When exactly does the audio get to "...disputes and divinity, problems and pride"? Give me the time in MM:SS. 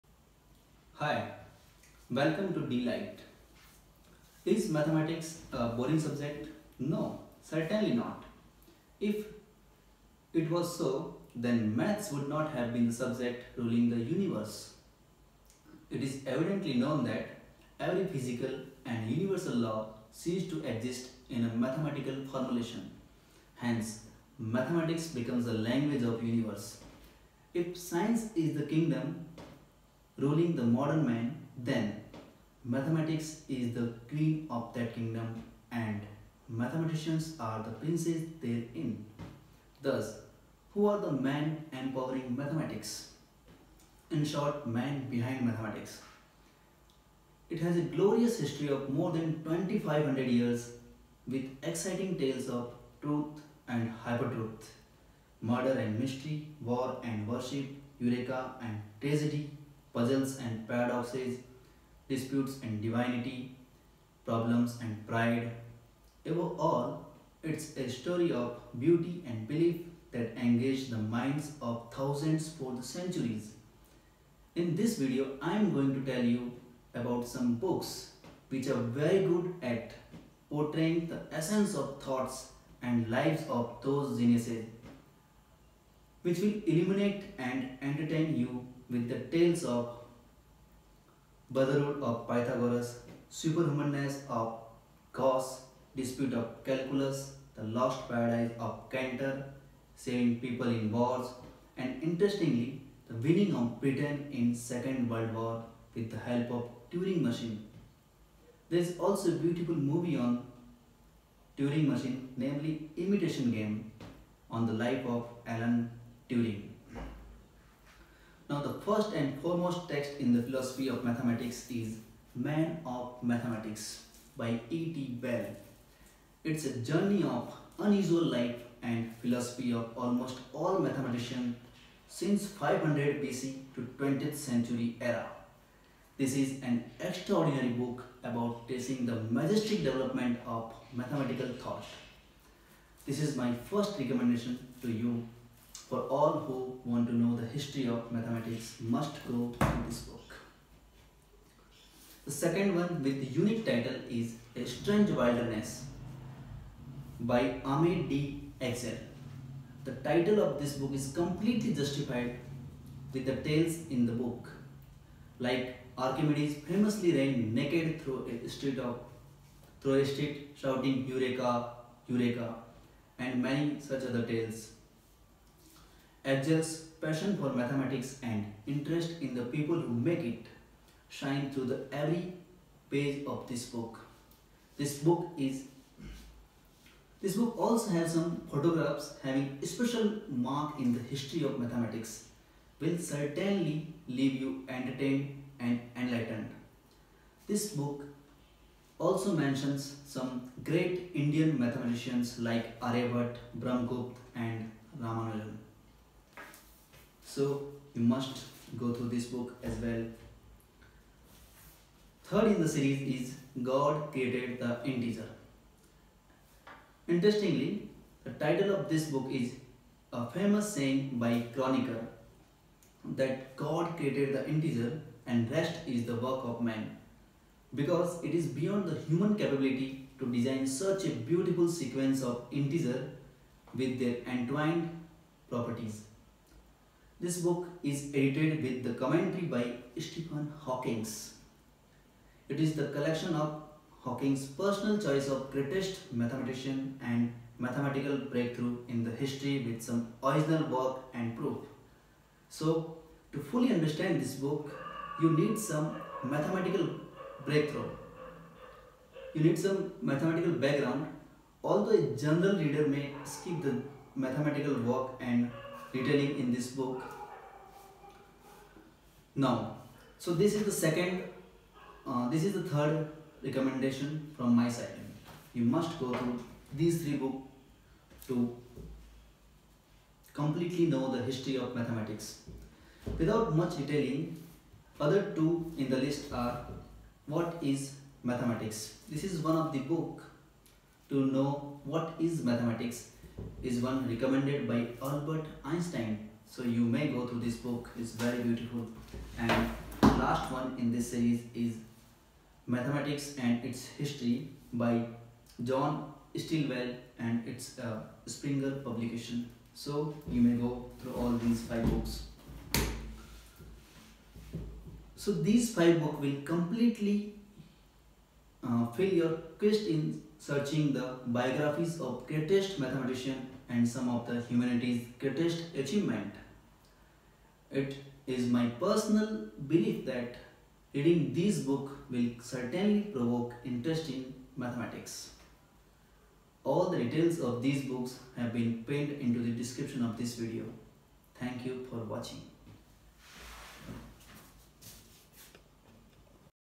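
01:02.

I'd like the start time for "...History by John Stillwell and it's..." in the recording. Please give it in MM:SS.
05:03.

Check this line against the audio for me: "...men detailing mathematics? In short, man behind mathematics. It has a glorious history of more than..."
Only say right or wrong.
wrong.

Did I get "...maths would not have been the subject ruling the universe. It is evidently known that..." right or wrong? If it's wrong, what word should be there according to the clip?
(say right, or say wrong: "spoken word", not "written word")
right.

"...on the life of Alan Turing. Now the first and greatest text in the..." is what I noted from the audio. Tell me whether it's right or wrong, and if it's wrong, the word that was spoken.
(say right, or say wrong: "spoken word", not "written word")
wrong: "foremost", not "greatest".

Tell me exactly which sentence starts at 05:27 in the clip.
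It is my personal belief that reading this book will certainly provoke interest in mathematics.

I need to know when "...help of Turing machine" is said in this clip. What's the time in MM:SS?
01:46.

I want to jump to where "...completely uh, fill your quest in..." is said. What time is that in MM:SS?
05:16.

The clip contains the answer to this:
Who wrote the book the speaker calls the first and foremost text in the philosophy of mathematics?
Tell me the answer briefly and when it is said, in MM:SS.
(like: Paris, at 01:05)
E.T. Bell, at 02:04.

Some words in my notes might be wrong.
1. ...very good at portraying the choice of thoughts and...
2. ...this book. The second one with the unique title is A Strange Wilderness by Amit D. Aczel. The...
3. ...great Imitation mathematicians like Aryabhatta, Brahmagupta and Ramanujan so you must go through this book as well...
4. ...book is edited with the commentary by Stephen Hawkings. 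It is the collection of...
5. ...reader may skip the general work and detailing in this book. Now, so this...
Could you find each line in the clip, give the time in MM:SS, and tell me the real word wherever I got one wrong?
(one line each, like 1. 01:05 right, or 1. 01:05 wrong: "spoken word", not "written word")
1. 01:18 wrong: "essence", not "choice"
2. 02:29 right
3. 03:20 wrong: "Indian", not "Imitation"
4. 03:57 right
5. 04:22 wrong: "mathematical", not "general".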